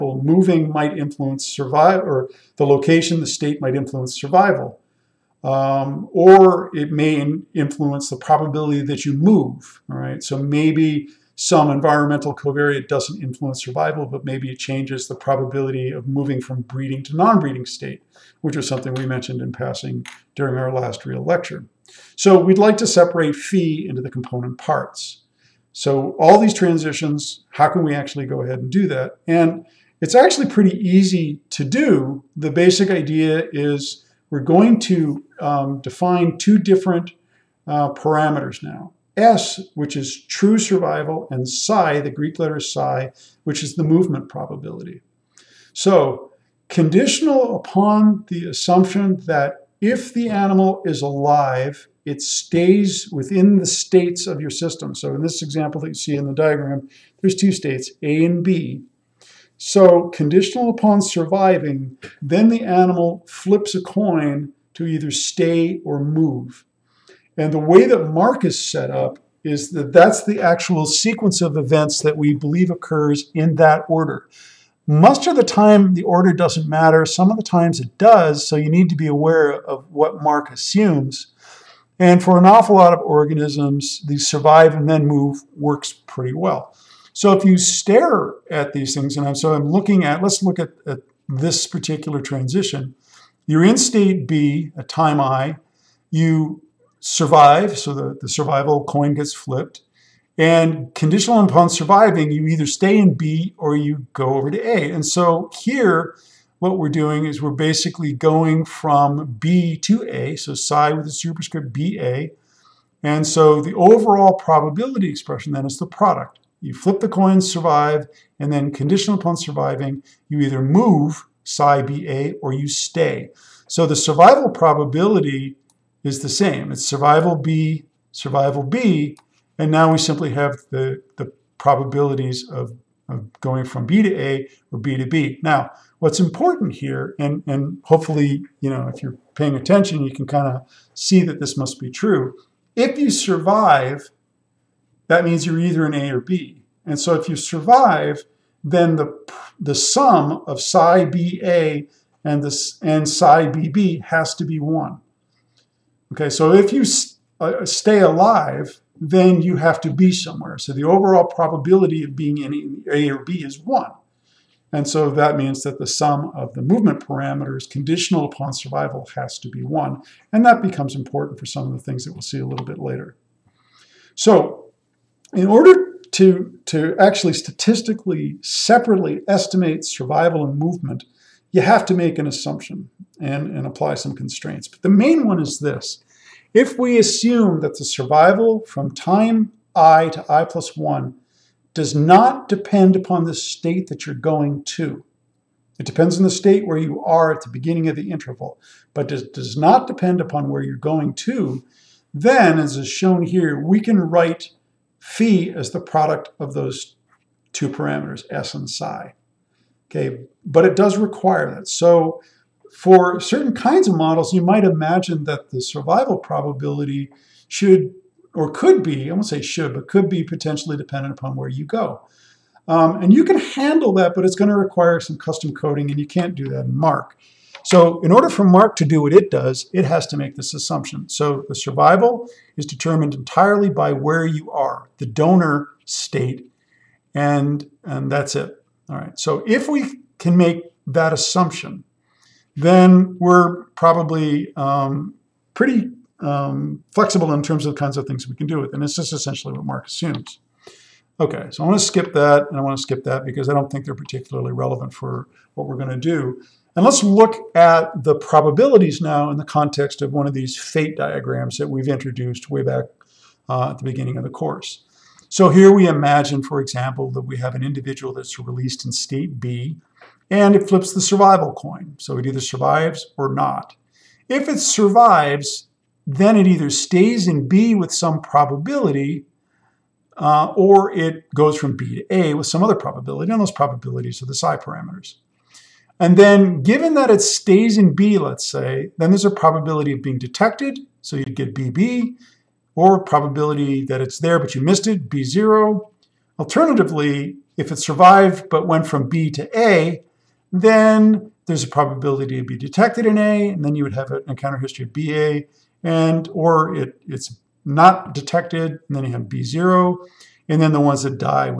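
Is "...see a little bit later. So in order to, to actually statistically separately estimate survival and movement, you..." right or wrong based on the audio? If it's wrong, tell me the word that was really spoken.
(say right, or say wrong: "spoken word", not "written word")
right.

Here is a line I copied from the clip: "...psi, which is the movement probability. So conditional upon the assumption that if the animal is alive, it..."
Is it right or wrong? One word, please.
right.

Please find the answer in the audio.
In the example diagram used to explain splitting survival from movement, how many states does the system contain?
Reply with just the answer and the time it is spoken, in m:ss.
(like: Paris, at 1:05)
2, at 0:57.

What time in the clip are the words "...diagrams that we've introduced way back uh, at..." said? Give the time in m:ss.
4:20.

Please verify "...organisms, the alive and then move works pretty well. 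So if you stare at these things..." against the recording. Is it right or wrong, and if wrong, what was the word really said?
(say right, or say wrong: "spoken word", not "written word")
wrong: "survive", not "alive".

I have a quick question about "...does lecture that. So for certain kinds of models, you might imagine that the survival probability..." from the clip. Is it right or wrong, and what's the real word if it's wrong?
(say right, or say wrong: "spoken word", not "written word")
wrong: "require", not "lecture".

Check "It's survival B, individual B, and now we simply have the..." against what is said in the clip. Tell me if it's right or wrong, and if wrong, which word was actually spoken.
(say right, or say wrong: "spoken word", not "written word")
wrong: "survival", not "individual".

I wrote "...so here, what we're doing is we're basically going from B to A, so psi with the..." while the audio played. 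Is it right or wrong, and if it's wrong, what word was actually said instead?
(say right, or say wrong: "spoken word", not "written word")
right.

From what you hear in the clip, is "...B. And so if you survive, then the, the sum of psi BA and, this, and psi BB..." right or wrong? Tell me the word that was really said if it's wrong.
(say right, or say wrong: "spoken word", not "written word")
right.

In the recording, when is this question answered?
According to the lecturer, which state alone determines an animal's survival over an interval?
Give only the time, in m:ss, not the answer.
3:54.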